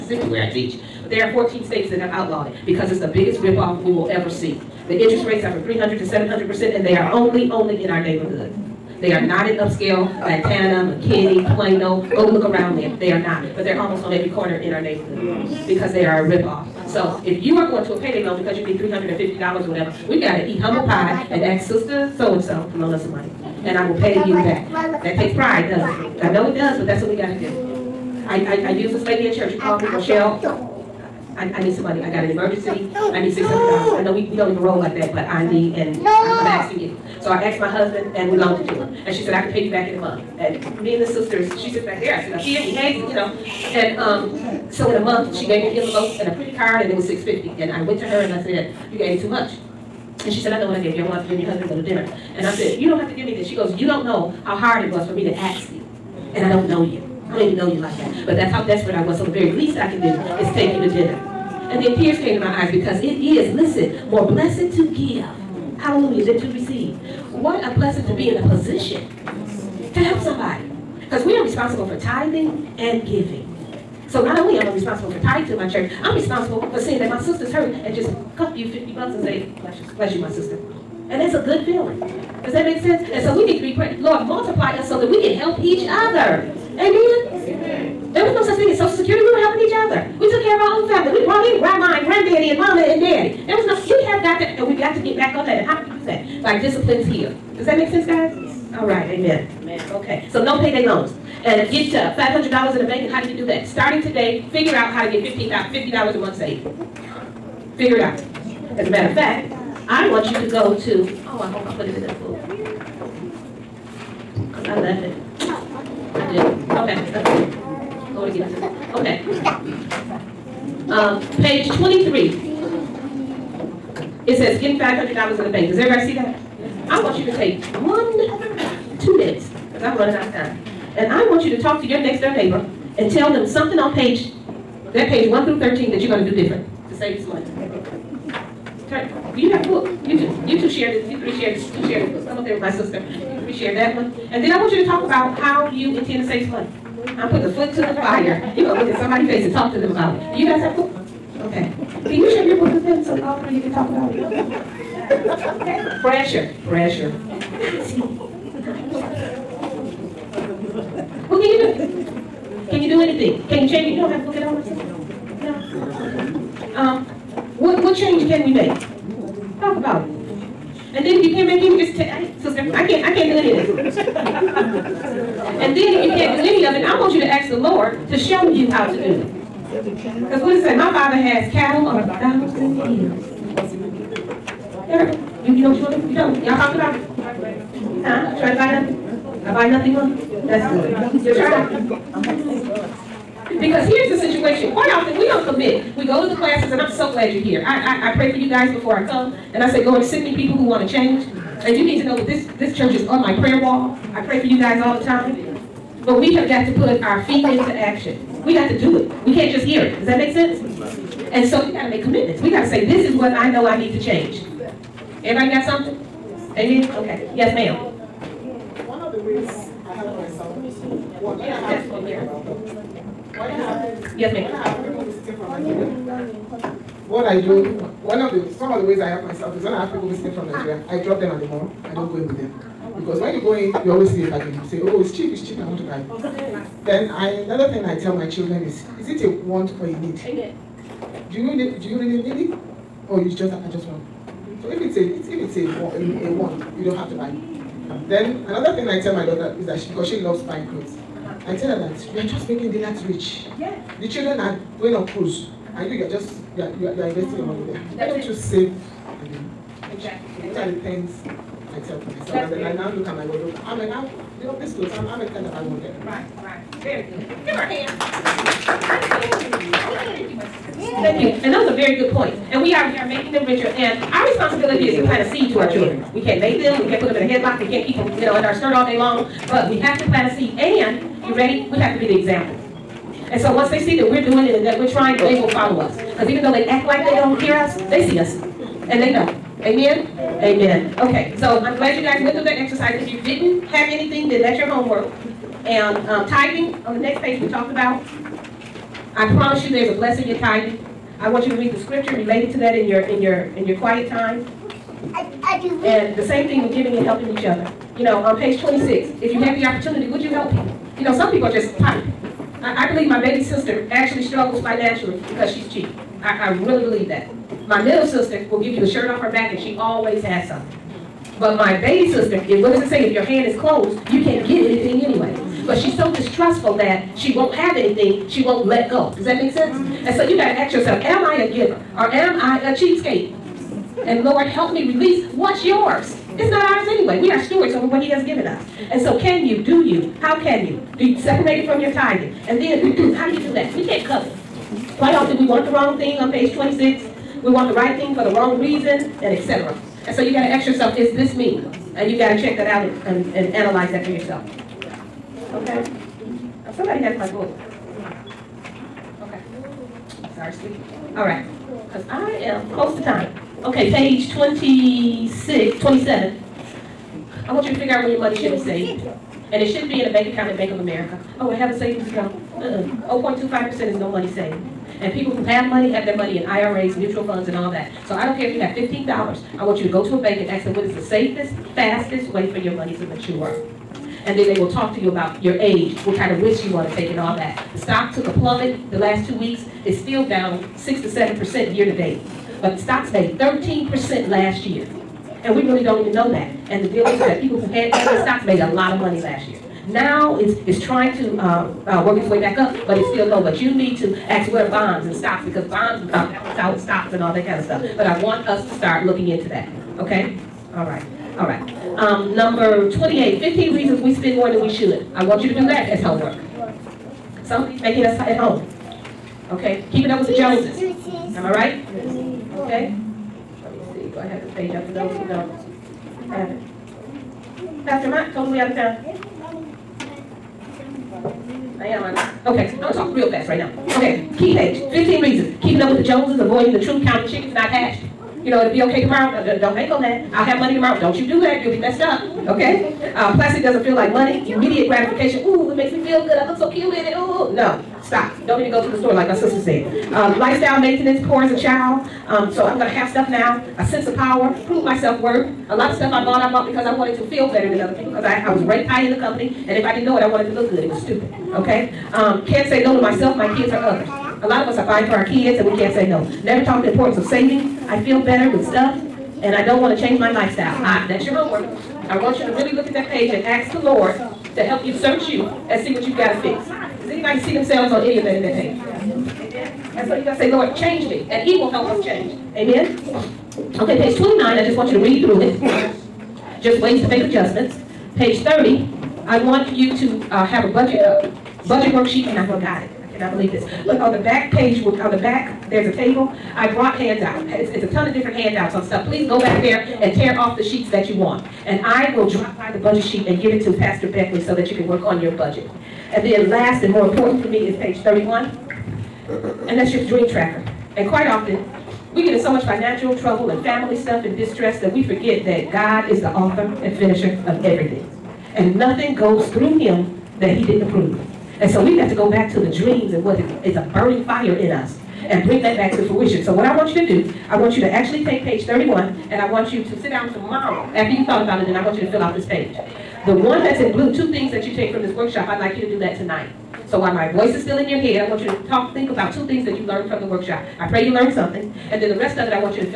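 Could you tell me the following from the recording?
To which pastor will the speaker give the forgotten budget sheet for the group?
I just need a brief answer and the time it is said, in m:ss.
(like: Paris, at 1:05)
Pastor Beckley, at 8:23.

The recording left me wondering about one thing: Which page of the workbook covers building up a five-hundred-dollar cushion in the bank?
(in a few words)
23.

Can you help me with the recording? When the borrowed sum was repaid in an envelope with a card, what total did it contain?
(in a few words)
$650.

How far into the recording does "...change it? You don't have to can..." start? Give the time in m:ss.
2:43.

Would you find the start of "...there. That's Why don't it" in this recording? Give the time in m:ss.
4:17.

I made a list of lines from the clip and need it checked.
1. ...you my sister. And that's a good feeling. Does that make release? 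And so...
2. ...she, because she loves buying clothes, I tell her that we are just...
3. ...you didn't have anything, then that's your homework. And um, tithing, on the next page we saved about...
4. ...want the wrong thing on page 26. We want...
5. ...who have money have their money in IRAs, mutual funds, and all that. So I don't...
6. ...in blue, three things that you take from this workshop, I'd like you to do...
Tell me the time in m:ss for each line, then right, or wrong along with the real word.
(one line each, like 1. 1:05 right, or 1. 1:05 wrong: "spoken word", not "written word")
1. 1:20 wrong: "sense", not "release"
2. 4:09 right
3. 4:53 wrong: "talked", not "saved"
4. 5:45 right
5. 6:15 right
6. 8:53 wrong: "two", not "three".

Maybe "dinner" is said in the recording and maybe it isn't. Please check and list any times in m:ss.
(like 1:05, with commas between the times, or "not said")
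0:51, 1:00.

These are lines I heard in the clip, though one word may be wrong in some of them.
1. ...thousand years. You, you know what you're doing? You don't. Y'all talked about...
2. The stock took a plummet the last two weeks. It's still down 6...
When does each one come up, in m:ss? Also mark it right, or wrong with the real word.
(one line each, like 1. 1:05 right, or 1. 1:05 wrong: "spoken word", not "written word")
1. 3:02 right
2. 6:27 right.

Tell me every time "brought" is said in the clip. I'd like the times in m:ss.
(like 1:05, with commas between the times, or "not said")
1:31, 8:16.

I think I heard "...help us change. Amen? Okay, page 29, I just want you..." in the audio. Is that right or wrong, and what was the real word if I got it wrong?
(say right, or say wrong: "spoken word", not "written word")
right.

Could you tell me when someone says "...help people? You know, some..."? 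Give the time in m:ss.
5:10.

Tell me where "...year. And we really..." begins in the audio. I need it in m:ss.
6:34.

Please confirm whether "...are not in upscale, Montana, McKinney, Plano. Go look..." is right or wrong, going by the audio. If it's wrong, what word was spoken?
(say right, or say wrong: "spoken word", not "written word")
right.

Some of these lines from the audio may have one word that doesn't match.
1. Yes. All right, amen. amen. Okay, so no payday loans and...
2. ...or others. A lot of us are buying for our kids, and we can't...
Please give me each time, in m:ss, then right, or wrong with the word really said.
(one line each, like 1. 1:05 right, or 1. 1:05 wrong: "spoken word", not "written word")
1. 1:38 right
2. 7:43 right.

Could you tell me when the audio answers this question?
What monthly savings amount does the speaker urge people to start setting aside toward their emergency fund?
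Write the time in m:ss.
1:45.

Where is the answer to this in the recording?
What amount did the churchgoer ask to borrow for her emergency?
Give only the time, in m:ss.
0:33.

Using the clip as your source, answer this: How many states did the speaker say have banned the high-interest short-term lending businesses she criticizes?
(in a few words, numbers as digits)
14.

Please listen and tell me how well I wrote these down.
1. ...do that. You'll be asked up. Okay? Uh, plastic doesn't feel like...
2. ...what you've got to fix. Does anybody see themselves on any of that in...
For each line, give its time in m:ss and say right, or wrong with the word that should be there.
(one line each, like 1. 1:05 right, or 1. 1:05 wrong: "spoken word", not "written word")
1. 7:21 wrong: "messed", not "asked"
2. 7:55 right.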